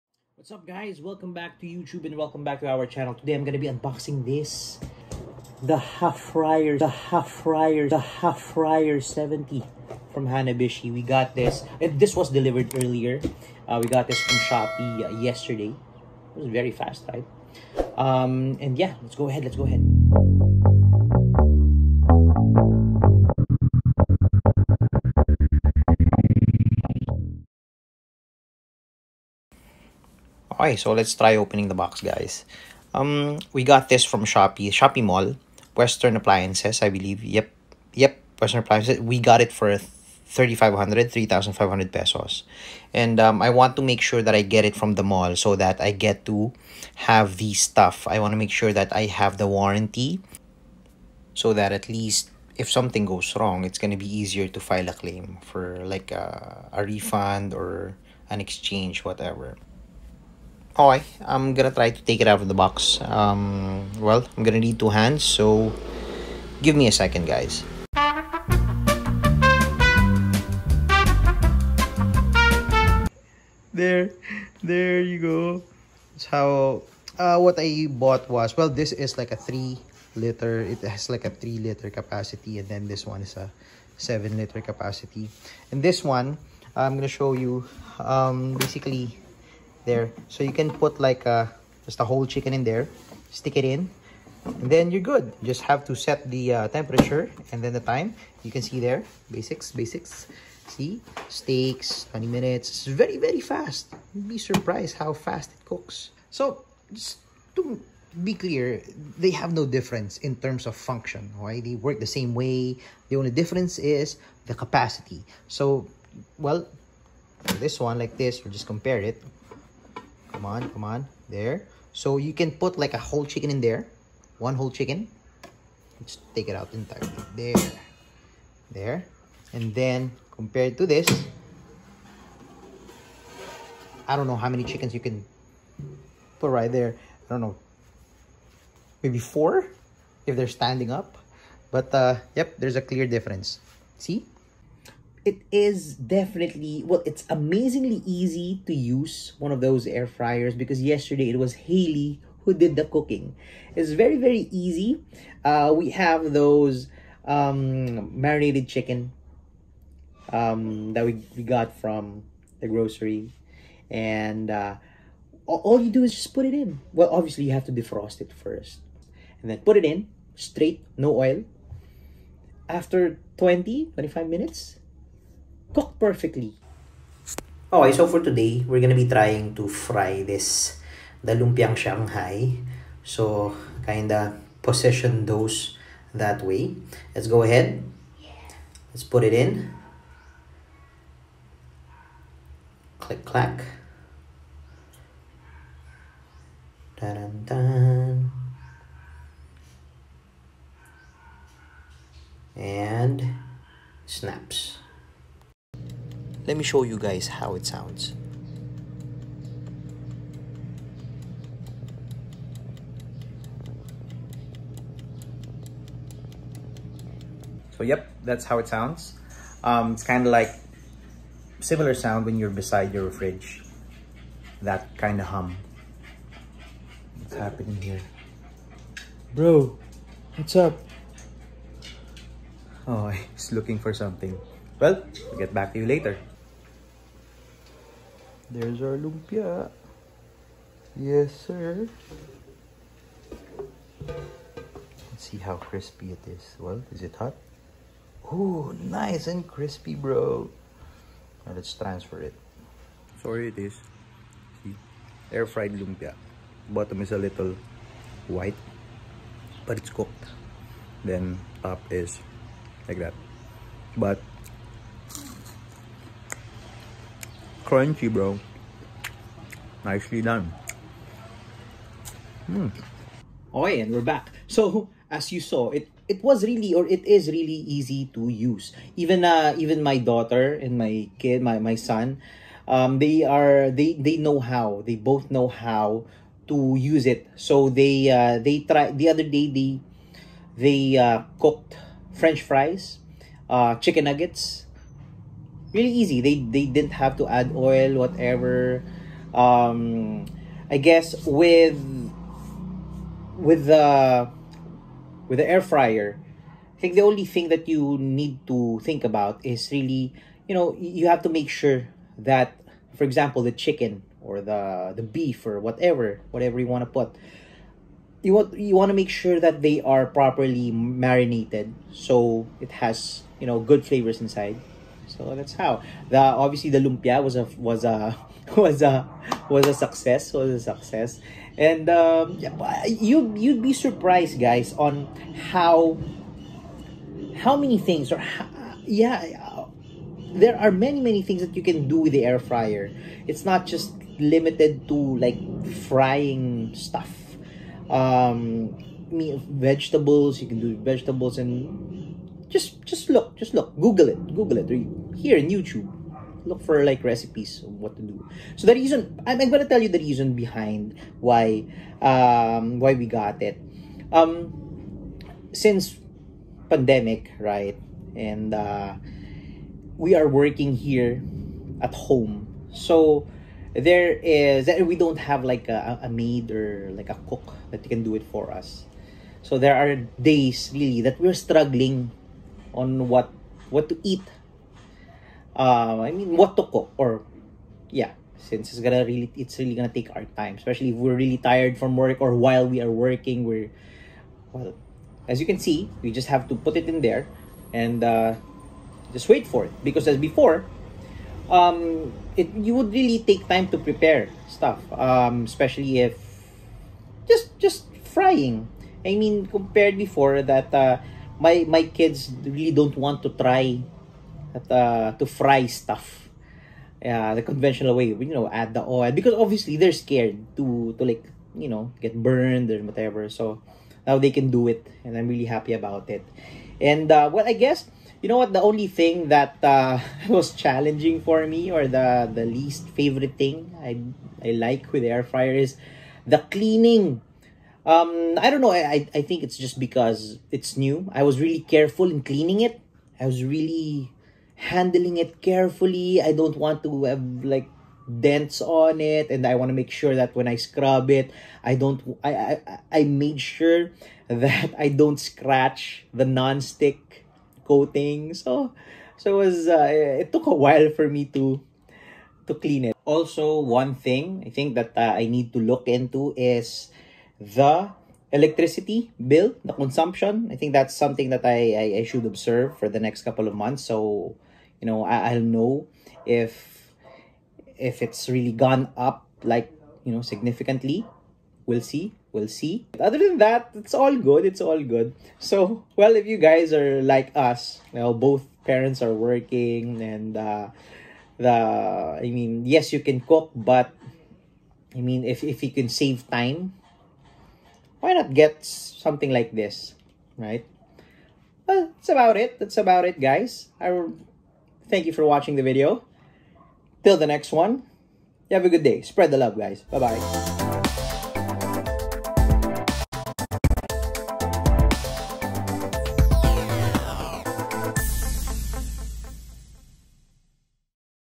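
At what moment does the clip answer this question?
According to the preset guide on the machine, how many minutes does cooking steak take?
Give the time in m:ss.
1:42.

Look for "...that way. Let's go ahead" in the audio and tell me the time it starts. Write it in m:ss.
3:06.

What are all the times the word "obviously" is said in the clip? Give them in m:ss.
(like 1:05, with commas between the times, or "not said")
2:47, 5:26, 6:59.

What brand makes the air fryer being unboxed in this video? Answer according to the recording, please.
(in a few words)
Hanabishi.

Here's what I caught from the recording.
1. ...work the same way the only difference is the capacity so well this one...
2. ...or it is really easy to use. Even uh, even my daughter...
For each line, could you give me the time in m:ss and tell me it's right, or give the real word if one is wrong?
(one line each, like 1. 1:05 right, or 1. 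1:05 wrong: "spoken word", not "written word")
1. 1:51 right
2. 4:36 right.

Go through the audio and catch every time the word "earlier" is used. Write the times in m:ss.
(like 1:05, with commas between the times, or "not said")
0:12.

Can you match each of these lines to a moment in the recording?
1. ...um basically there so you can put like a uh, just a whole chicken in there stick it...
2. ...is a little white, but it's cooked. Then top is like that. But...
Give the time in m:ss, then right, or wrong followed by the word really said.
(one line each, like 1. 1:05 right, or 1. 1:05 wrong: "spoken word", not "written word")
1. 1:27 right
2. 4:17 right.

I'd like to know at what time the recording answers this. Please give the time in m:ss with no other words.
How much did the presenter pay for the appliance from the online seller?
0:41.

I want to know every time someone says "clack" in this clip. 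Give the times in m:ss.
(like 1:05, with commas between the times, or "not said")
3:13.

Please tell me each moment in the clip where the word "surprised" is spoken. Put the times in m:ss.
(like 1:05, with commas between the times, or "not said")
1:44, 5:33.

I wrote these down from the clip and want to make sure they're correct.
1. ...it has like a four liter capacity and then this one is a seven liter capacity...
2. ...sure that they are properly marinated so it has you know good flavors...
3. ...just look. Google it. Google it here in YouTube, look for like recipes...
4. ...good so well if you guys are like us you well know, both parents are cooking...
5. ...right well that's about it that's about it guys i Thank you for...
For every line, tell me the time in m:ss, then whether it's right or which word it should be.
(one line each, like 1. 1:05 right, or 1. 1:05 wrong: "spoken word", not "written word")
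1. 1:20 wrong: "three", not "four"
2. 5:19 right
3. 5:53 right
4. 8:04 wrong: "working", not "cooking"
5. 8:20 right.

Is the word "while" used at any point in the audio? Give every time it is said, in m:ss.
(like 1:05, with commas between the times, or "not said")
6:32, 7:40.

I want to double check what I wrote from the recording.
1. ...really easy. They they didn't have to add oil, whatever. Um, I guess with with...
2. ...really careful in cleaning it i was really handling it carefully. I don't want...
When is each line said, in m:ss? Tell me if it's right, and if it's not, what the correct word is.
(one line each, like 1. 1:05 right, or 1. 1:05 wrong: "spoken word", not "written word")
1. 4:55 right
2. 7:21 right.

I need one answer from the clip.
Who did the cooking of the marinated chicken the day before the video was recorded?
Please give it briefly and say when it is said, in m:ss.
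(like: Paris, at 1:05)
Haley, at 2:31.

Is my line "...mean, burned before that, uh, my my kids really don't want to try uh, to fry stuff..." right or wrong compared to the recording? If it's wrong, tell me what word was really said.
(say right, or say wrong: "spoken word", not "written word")
wrong: "compared", not "burned".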